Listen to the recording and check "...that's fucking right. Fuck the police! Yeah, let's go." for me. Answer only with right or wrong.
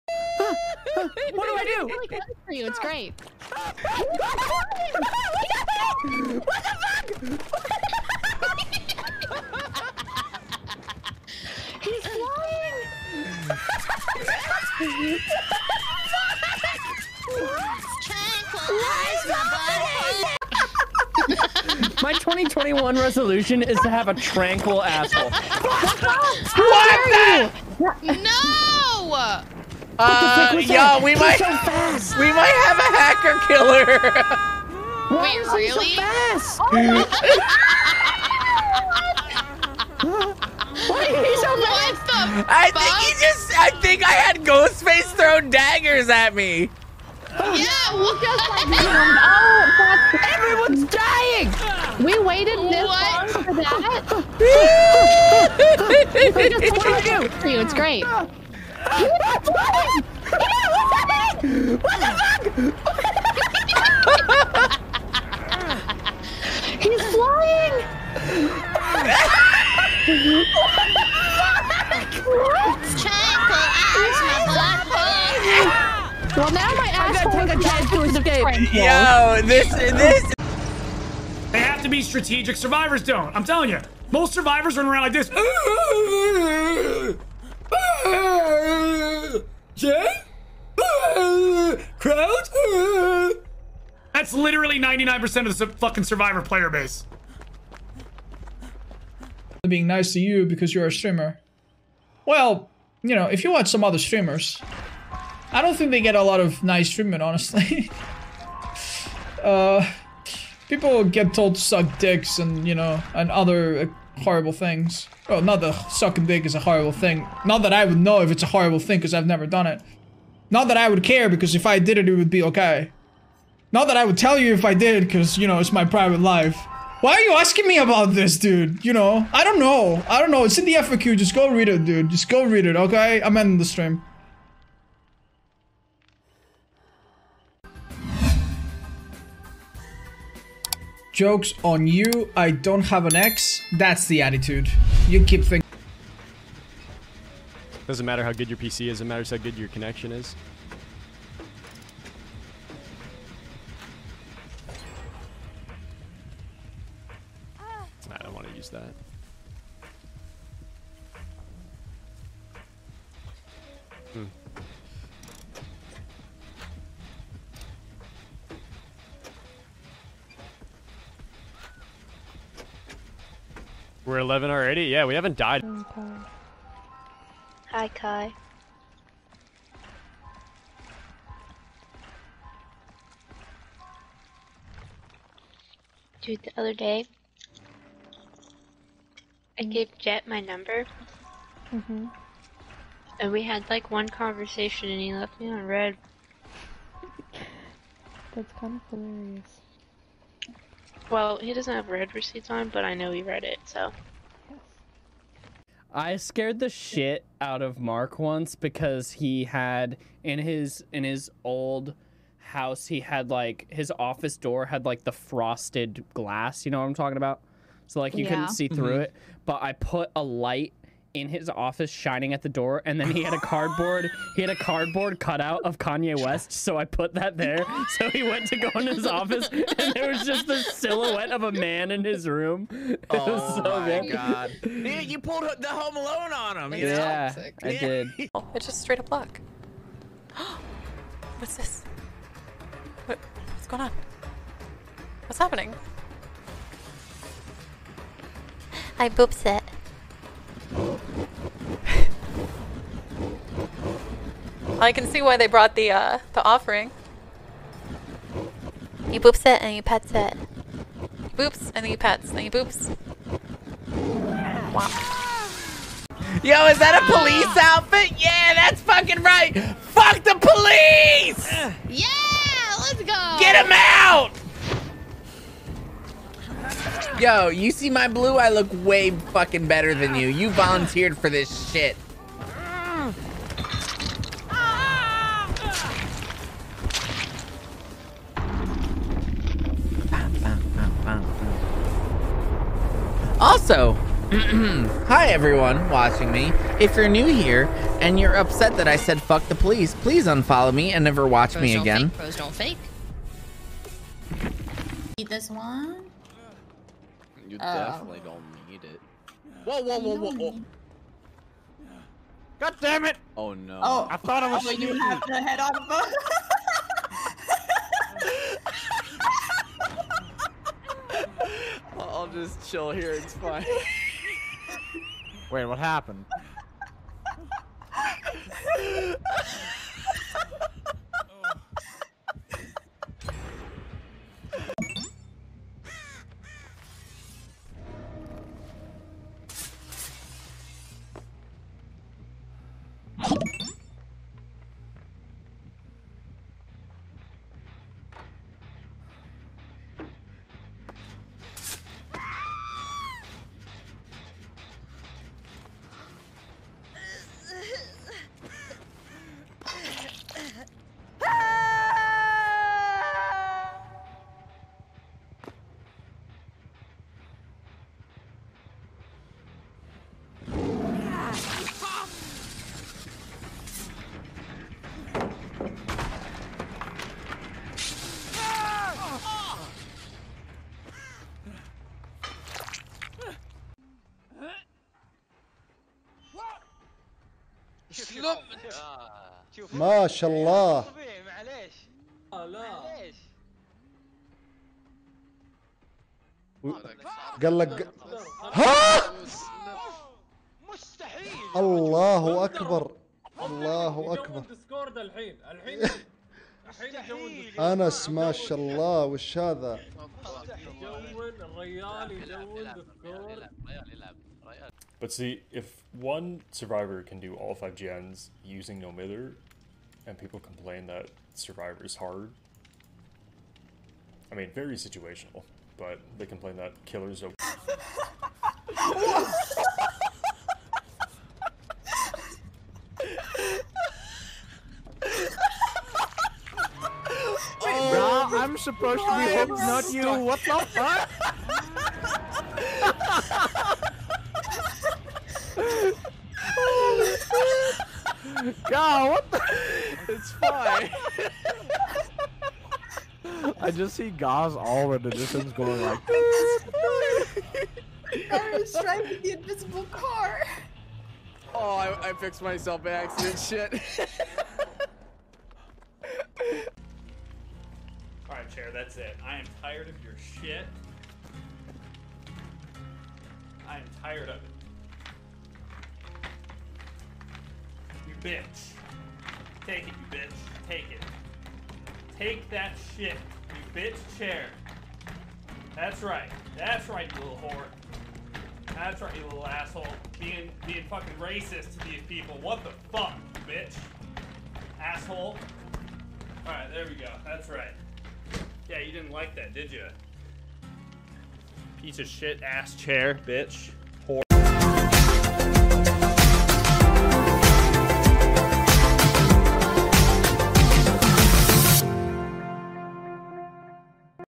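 right.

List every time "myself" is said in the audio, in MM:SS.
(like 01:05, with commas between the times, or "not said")
07:42.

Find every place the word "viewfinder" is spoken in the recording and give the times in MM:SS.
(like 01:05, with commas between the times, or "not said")
not said.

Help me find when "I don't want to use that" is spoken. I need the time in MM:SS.
02:37.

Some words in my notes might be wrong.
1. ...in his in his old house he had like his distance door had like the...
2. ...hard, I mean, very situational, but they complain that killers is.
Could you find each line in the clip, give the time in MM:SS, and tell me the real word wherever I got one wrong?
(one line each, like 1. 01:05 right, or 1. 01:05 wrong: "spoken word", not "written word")
1. 03:30 wrong: "office", not "distance"
2. 07:01 right.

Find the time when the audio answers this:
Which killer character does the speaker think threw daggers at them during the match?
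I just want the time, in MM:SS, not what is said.
00:44.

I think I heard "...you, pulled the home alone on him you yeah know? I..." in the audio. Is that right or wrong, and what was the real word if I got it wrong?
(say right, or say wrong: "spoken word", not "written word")
right.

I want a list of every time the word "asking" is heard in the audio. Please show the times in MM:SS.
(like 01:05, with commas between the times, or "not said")
02:07.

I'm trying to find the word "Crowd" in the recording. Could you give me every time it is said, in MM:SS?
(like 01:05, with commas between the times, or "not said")
01:31.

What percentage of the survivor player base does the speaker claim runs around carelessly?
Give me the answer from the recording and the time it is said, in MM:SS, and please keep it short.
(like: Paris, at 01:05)
99%, at 01:34.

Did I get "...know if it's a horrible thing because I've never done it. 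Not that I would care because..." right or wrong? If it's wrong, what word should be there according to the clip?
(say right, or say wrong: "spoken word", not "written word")
right.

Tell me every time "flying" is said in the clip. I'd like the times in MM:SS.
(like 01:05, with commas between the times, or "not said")
00:12, 01:07.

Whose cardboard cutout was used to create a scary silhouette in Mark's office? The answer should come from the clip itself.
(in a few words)
Kanye West.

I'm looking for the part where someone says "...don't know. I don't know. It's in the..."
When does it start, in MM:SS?
02:09.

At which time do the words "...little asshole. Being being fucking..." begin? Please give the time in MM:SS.
08:09.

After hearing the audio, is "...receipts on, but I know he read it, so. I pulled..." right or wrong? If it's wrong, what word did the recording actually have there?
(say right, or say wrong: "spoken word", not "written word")
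wrong: "scared", not "pulled".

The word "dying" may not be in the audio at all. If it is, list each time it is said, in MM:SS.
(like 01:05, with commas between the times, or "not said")
00:50.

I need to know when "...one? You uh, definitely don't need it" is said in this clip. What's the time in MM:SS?
05:05.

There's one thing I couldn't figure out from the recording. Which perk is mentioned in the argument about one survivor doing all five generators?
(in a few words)
No Mither.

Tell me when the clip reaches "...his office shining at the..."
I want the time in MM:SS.
03:41.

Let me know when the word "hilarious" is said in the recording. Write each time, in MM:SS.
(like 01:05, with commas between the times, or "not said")
03:18.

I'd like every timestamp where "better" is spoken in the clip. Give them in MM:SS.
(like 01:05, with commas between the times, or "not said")
04:39.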